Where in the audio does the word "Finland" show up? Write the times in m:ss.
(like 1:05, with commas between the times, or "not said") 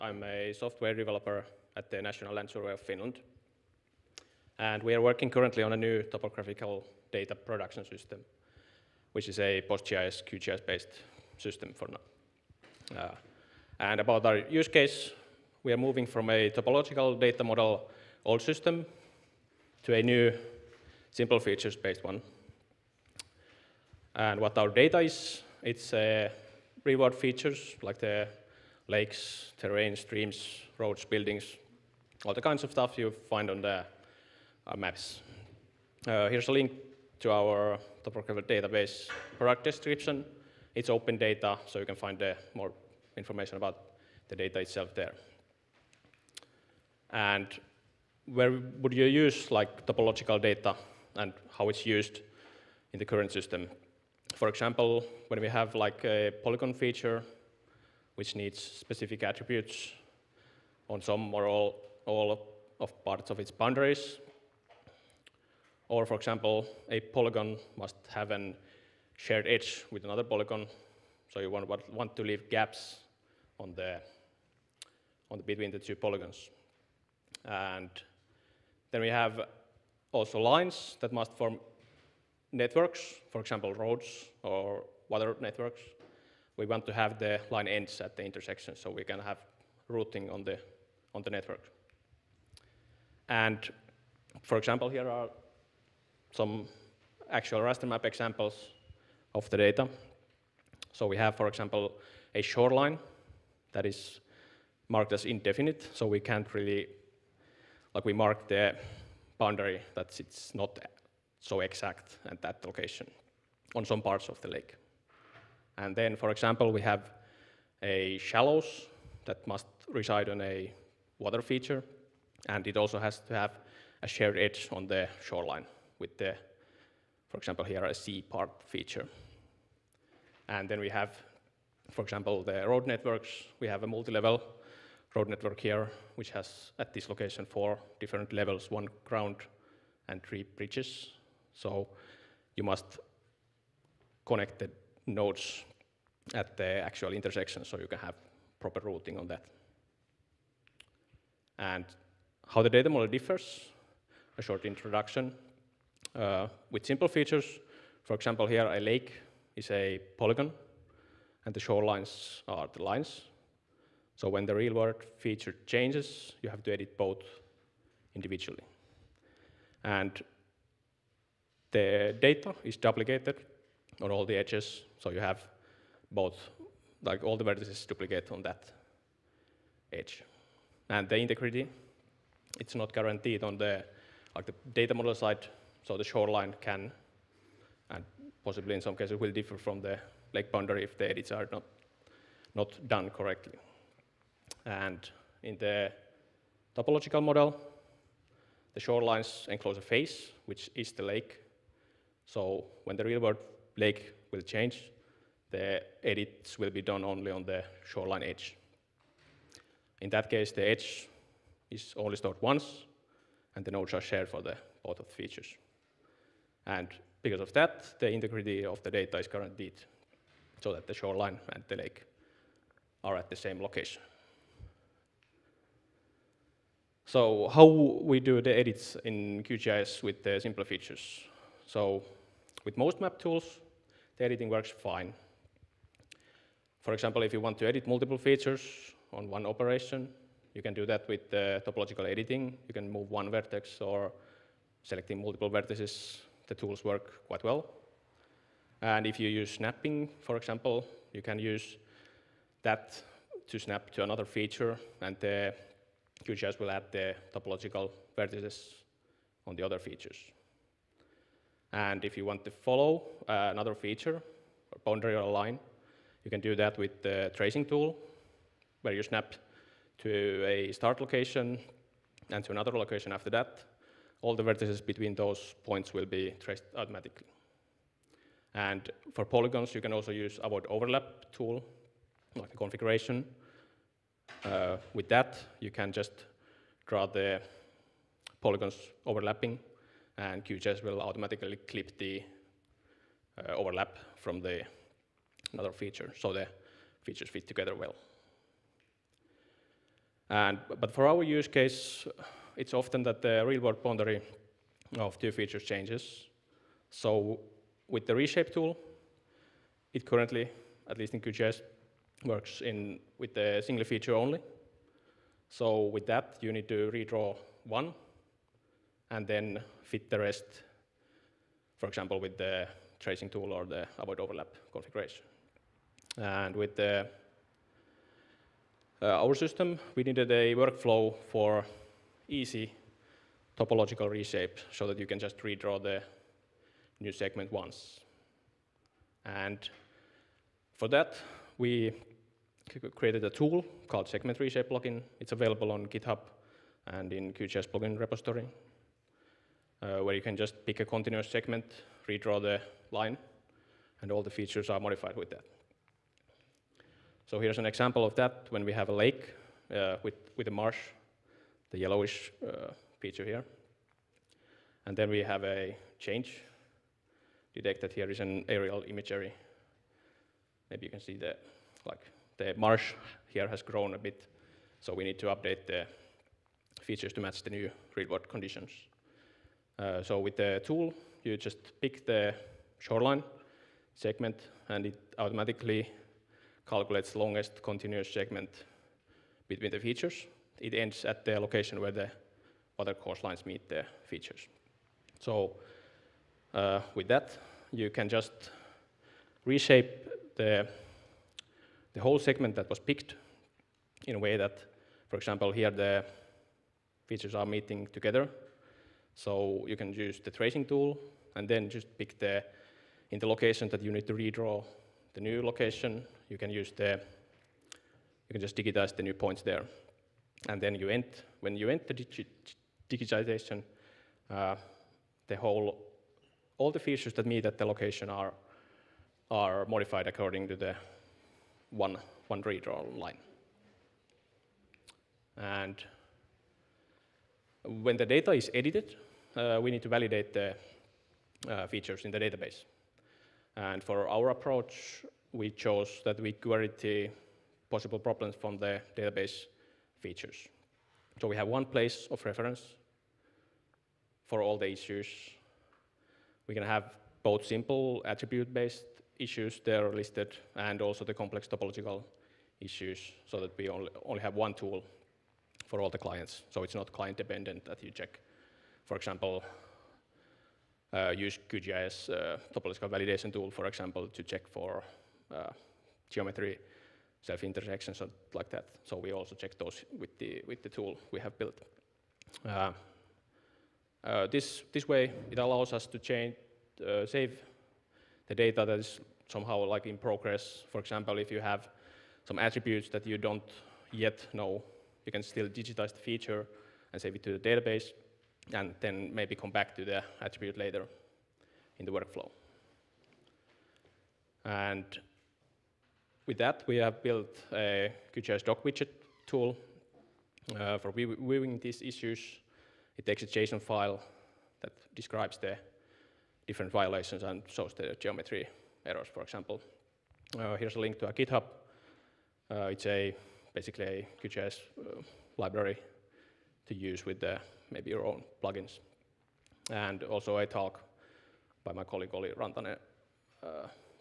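0:02.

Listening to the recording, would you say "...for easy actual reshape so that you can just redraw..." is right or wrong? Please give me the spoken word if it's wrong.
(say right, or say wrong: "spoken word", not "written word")
wrong: "topological", not "actual".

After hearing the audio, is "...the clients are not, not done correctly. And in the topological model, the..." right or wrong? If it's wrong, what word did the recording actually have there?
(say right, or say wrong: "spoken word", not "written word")
wrong: "edits", not "clients".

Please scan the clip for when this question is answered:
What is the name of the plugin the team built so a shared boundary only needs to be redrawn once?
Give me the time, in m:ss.
5:44.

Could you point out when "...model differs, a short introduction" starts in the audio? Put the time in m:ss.
2:32.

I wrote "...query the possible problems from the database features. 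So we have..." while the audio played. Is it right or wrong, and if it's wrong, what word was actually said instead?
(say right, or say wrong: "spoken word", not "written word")
right.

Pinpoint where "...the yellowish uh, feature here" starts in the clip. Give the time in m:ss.
6:01.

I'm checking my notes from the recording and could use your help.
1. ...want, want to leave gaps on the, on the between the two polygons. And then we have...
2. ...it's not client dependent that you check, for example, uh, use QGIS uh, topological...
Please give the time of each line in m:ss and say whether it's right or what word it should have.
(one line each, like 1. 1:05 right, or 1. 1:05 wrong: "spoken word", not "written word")
1. 1:11 right
2. 7:46 right.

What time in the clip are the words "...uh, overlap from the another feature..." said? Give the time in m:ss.
4:53.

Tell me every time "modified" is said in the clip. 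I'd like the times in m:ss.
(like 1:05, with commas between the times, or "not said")
5:54, 7:09.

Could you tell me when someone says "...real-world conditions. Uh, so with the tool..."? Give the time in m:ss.
6:17.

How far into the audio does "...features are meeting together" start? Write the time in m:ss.
6:47.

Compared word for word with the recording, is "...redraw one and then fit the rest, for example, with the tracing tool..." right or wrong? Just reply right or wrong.
right.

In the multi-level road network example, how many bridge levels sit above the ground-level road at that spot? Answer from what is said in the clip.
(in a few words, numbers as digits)
3.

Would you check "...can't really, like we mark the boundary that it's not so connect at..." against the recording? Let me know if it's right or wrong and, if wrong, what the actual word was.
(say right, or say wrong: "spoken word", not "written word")
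wrong: "exact", not "connect".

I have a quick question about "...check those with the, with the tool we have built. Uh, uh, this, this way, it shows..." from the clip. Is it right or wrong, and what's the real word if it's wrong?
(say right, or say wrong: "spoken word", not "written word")
wrong: "allows", not "shows".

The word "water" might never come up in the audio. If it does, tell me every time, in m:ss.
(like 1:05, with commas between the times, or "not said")
1:25, 2:01, 6:32.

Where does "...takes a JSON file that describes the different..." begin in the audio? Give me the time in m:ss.
8:33.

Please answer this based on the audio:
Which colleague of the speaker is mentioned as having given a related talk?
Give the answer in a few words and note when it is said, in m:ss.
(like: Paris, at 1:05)
Olli Rantanen, at 8:52.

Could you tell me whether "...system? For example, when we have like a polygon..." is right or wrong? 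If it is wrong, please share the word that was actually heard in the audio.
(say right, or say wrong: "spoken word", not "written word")
right.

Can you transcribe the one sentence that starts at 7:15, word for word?
And when the data is edited, uh, we need to validate the uh, features in the database.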